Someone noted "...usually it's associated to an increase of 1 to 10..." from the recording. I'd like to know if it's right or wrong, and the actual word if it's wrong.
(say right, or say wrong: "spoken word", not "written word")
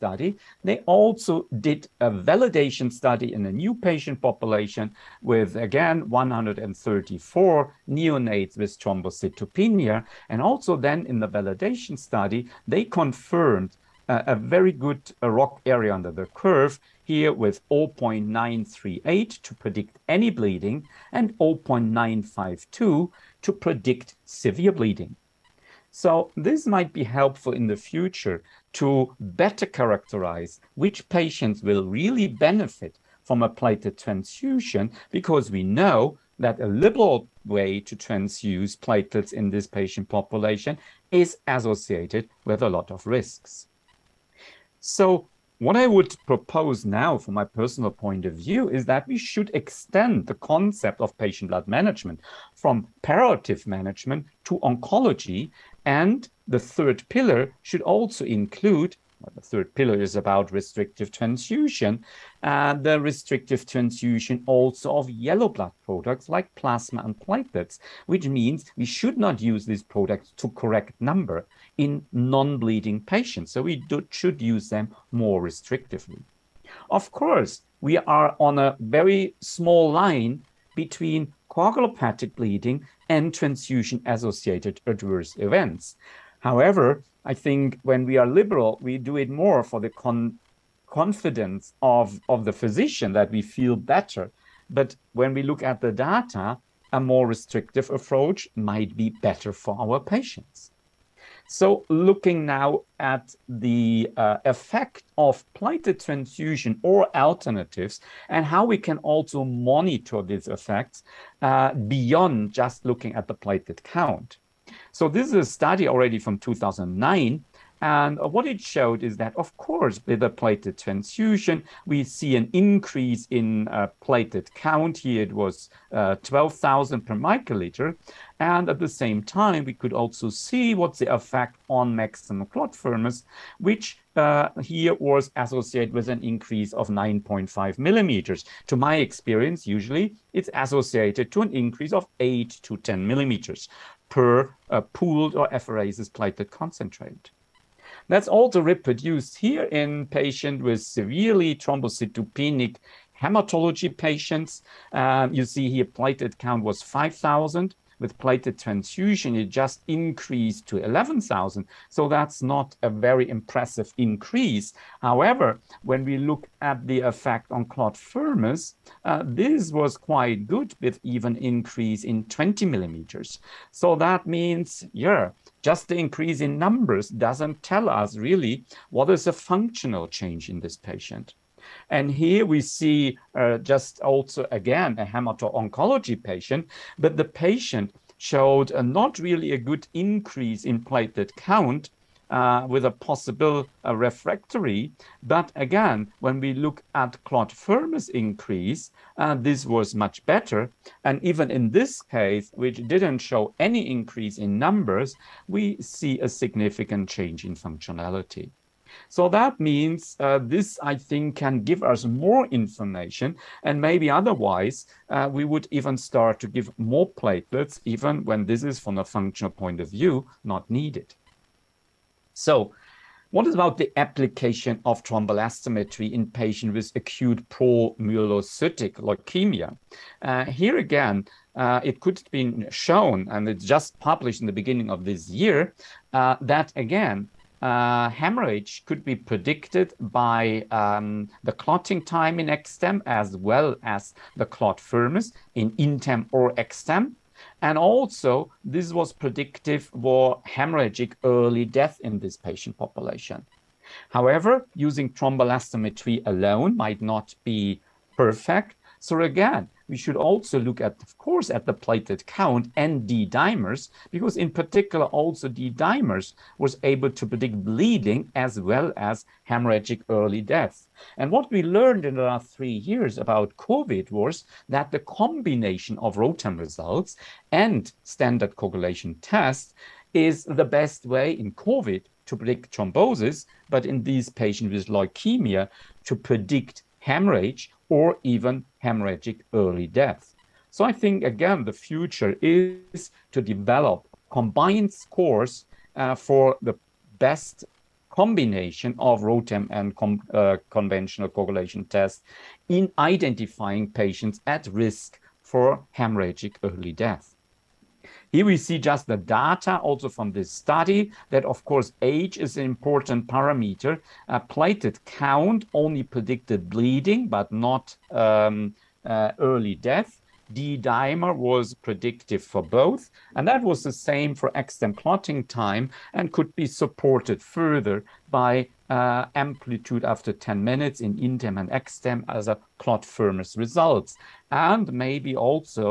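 wrong: "8", not "1".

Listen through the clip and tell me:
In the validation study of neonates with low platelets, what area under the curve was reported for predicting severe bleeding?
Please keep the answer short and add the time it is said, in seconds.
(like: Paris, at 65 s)
0.952, at 21 s.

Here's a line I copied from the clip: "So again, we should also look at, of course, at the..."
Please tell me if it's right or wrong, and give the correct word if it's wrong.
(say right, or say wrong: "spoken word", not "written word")
right.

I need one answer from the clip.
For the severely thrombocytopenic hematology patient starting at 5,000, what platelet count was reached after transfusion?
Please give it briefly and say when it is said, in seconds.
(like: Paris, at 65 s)
11,000, at 160 s.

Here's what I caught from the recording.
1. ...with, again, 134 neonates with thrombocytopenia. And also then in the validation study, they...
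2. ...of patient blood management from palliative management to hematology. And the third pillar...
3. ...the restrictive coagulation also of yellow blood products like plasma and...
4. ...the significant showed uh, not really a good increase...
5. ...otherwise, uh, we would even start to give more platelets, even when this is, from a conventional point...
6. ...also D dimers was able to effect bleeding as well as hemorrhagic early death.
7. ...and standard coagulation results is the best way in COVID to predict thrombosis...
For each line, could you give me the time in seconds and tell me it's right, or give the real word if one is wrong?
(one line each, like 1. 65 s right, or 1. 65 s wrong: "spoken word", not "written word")
1. 5 s right
2. 51 s wrong: "oncology", not "hematology"
3. 62 s wrong: "transfusion", not "coagulation"
4. 187 s wrong: "patient", not "significant"
5. 214 s wrong: "functional", not "conventional"
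6. 265 s wrong: "predict", not "effect"
7. 277 s wrong: "tests", not "results".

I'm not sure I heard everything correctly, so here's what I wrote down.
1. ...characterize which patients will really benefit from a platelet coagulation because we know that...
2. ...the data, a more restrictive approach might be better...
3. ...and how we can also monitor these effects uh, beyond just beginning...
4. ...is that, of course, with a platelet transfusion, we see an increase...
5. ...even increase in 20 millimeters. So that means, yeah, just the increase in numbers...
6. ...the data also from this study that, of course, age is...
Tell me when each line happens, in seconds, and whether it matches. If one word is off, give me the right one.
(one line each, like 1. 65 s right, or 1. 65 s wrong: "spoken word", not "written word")
1. 29 s wrong: "transfusion", not "coagulation"
2. 95 s right
3. 108 s wrong: "looking", not "beginning"
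4. 119 s right
5. 171 s right
6. 309 s right.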